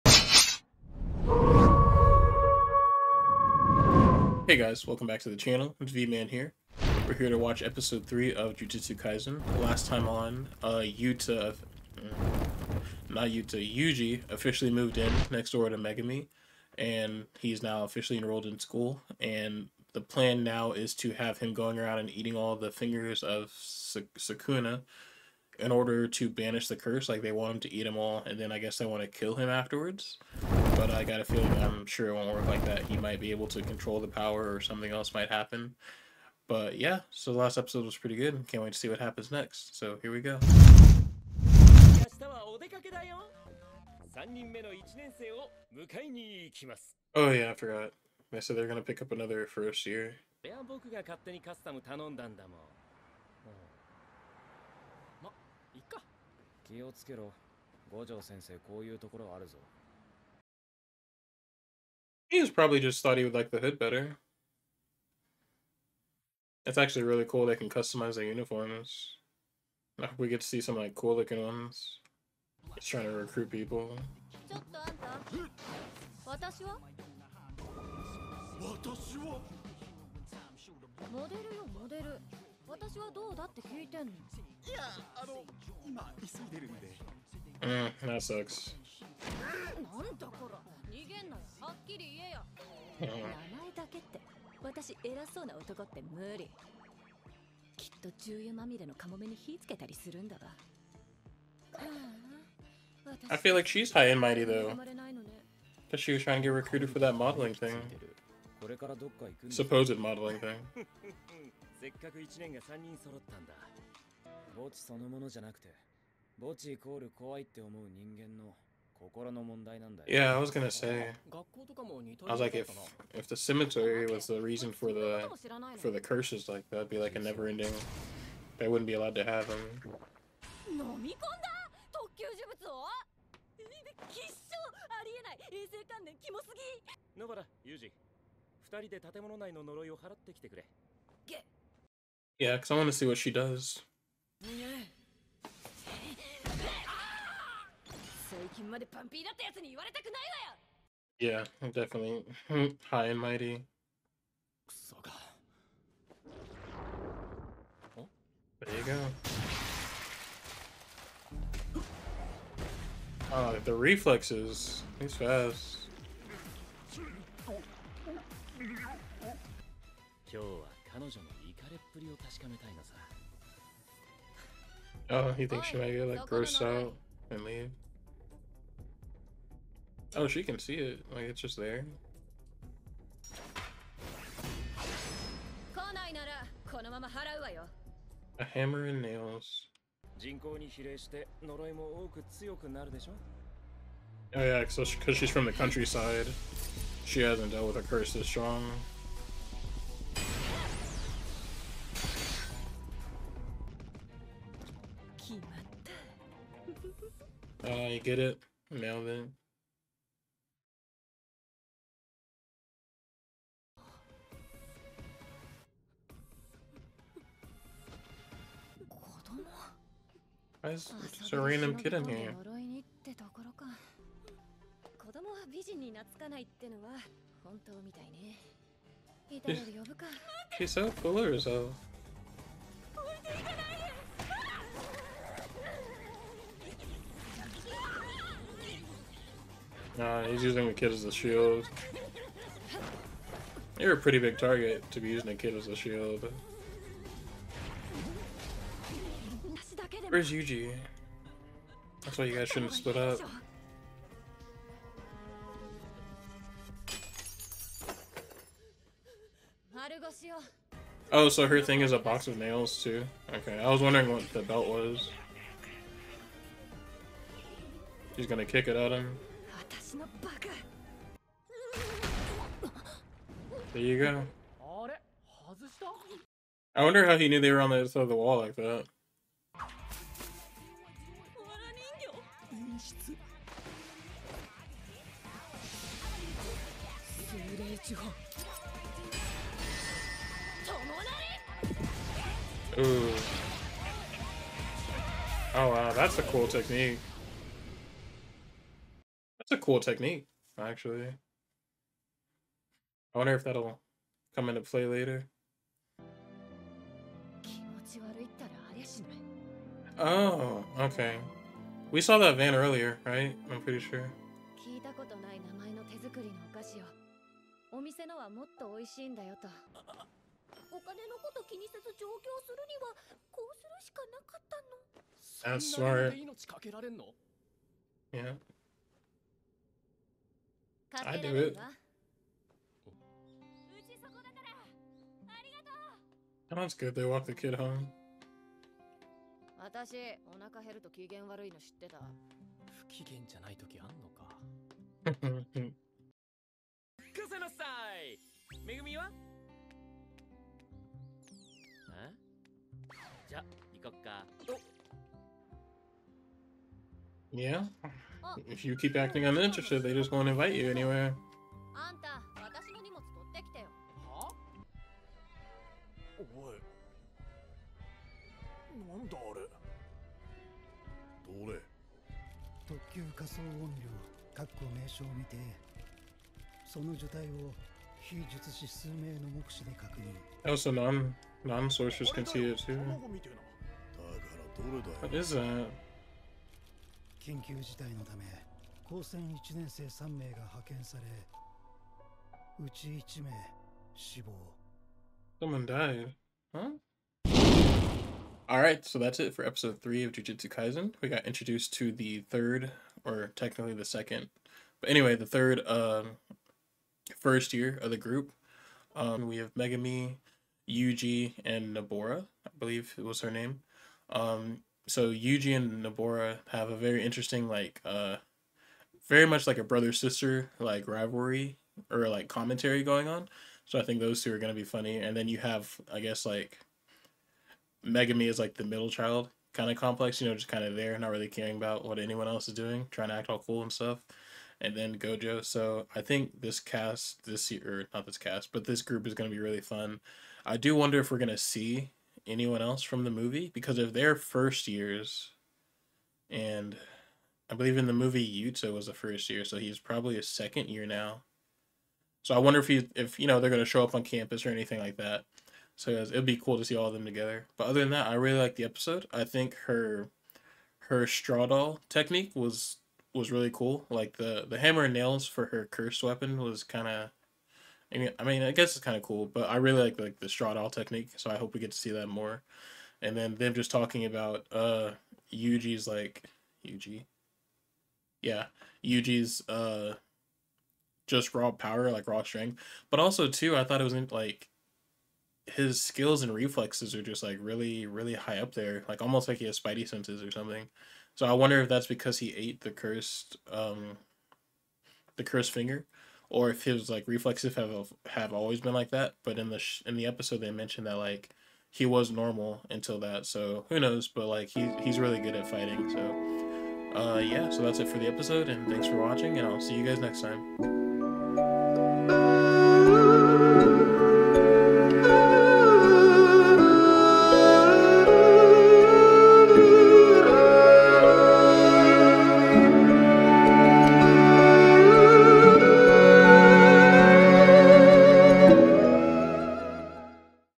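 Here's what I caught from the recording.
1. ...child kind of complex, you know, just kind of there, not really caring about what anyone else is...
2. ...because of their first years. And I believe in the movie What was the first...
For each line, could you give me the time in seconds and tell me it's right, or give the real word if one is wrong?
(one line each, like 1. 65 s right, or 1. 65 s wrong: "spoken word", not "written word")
1. 428 s right
2. 443 s wrong: "Yuta", not "What".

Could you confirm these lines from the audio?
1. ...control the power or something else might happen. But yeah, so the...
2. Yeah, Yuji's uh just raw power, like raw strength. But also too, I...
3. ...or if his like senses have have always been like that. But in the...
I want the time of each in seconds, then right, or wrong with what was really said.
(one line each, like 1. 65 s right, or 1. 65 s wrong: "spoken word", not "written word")
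1. 33 s right
2. 478 s right
3. 496 s wrong: "reflexes", not "senses".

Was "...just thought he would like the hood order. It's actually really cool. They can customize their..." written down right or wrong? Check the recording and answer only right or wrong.
wrong.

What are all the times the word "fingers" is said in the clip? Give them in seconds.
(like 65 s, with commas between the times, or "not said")
22 s, 495 s.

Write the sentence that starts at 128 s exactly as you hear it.
They wouldn't be allowed to have them.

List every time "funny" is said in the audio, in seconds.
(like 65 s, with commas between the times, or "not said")
424 s.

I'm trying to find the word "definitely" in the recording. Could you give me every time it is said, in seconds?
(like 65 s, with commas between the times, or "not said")
151 s.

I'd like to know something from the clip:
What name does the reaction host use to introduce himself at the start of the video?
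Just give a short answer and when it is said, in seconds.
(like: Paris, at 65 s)
V-Man, at 5 s.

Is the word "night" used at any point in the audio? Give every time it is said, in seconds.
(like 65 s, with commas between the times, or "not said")
not said.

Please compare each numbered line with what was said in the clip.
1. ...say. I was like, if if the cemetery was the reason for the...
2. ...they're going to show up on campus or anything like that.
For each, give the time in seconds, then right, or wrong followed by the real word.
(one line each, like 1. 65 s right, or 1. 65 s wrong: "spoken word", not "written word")
1. 120 s right
2. 453 s right.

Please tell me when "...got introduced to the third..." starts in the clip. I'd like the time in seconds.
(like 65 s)
401 s.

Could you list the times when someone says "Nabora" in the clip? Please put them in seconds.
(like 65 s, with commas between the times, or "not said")
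411 s, 415 s.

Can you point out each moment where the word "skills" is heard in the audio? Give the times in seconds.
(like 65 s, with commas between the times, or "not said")
485 s.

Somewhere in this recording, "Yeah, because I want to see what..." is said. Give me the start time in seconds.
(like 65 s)
142 s.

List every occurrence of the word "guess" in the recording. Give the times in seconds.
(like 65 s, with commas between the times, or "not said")
28 s, 426 s, 468 s.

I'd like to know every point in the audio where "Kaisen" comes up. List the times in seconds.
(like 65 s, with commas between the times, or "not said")
8 s, 400 s.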